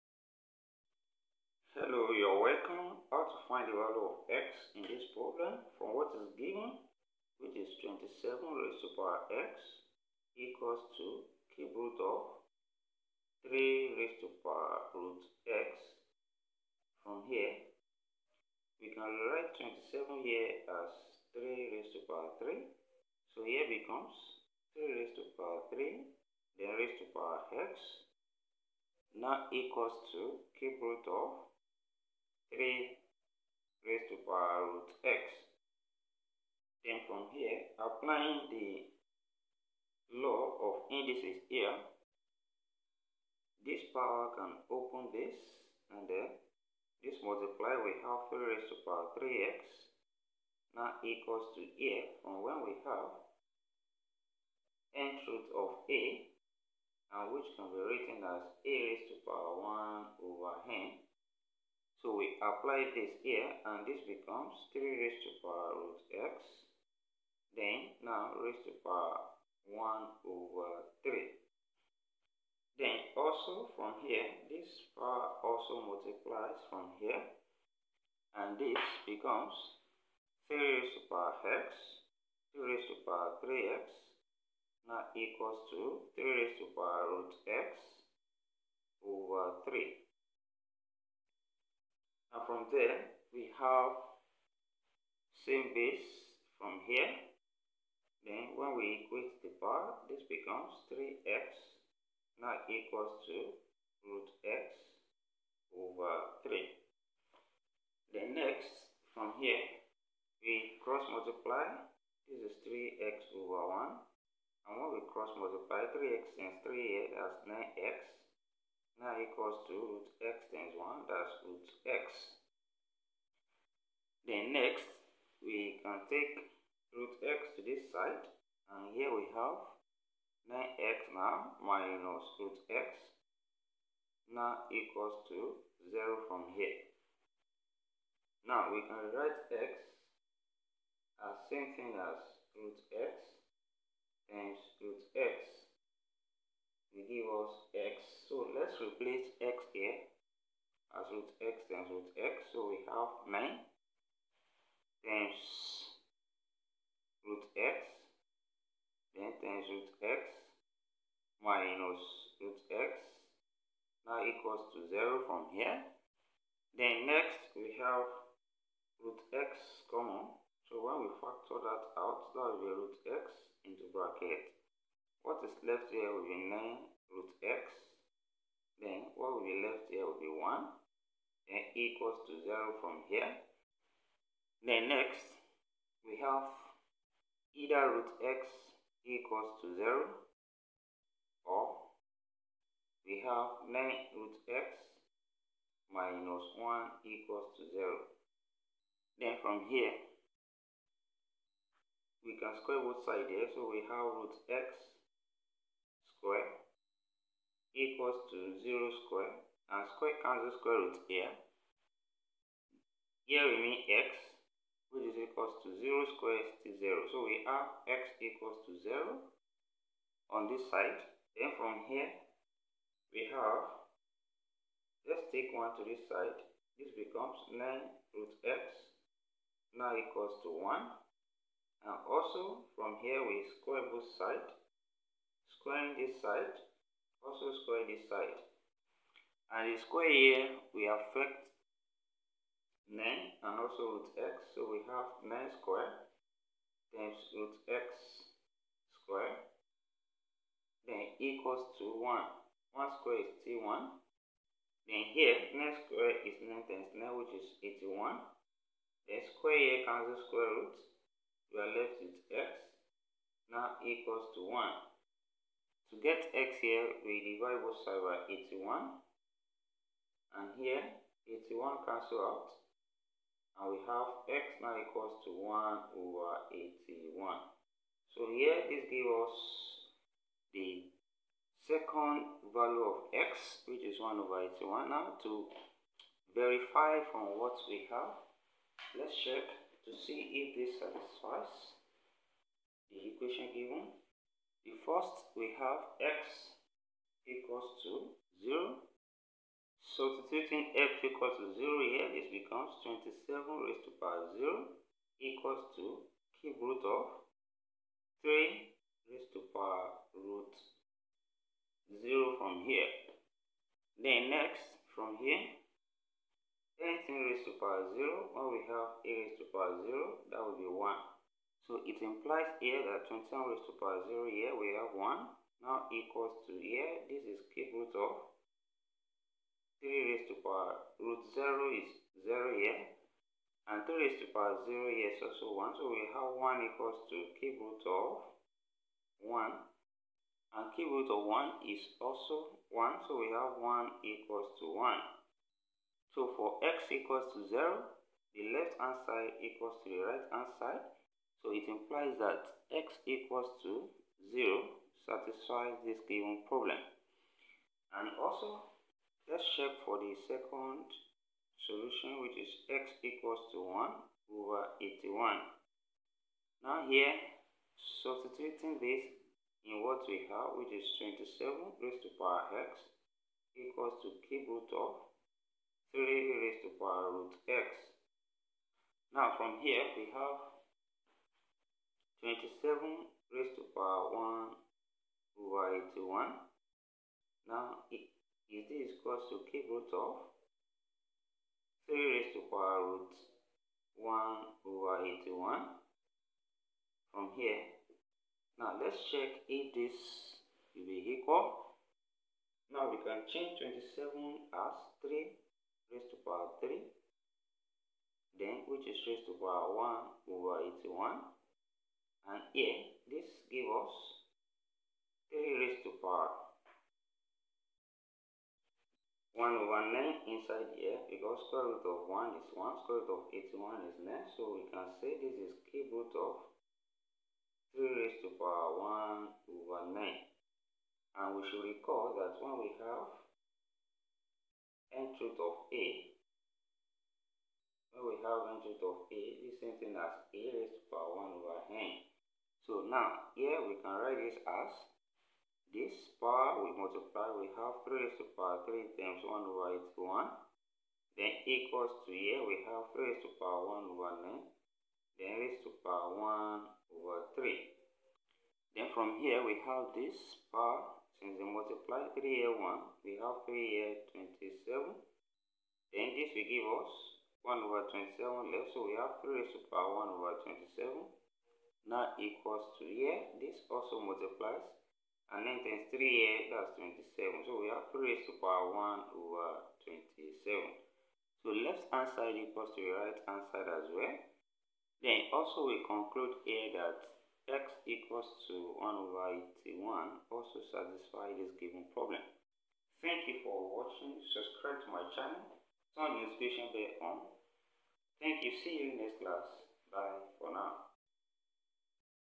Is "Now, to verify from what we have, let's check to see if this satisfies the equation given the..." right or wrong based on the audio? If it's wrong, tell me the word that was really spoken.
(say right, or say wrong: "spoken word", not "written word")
right.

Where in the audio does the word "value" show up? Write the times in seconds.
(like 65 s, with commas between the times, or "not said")
3 s, 282 s.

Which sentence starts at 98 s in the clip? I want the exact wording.
Then when we equate the bar, this becomes 3x now equals to root x over 3.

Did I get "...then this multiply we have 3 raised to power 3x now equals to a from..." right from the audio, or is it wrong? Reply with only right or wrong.
right.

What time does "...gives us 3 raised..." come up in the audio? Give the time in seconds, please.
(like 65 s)
413 s.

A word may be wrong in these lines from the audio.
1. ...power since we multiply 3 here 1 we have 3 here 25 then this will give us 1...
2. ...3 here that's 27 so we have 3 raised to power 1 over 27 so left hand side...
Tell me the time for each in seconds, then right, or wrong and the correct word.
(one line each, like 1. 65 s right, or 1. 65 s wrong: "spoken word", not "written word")
1. 460 s wrong: "27", not "25"
2. 475 s right.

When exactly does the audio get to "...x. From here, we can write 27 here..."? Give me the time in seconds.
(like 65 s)
15 s.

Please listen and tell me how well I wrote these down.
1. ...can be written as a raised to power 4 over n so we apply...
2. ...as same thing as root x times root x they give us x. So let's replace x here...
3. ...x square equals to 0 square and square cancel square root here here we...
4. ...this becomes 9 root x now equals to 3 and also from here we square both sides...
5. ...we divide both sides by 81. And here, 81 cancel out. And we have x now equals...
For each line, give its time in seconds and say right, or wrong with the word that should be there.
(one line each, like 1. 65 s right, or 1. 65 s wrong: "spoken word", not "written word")
1. 57 s wrong: "1", not "4"
2. 141 s right
3. 204 s right
4. 226 s wrong: "1", not "3"
5. 267 s right.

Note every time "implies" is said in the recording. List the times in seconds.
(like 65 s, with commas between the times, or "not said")
322 s, 351 s.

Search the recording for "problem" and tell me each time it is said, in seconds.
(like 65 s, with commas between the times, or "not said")
5 s, 356 s, 491 s.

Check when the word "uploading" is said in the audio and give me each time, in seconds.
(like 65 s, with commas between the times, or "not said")
not said.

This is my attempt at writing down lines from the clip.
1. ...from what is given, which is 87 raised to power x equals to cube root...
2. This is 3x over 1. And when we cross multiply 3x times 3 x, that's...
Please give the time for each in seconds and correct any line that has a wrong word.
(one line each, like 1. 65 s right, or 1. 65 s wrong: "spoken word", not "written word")
1. 5 s wrong: "27", not "87"
2. 112 s right.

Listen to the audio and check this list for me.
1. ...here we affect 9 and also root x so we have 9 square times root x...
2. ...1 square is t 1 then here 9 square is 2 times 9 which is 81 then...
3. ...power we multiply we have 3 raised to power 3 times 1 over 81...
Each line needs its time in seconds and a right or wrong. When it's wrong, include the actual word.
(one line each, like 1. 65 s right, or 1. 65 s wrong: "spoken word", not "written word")
1. 240 s right
2. 252 s wrong: "9", not "2"
3. 446 s right.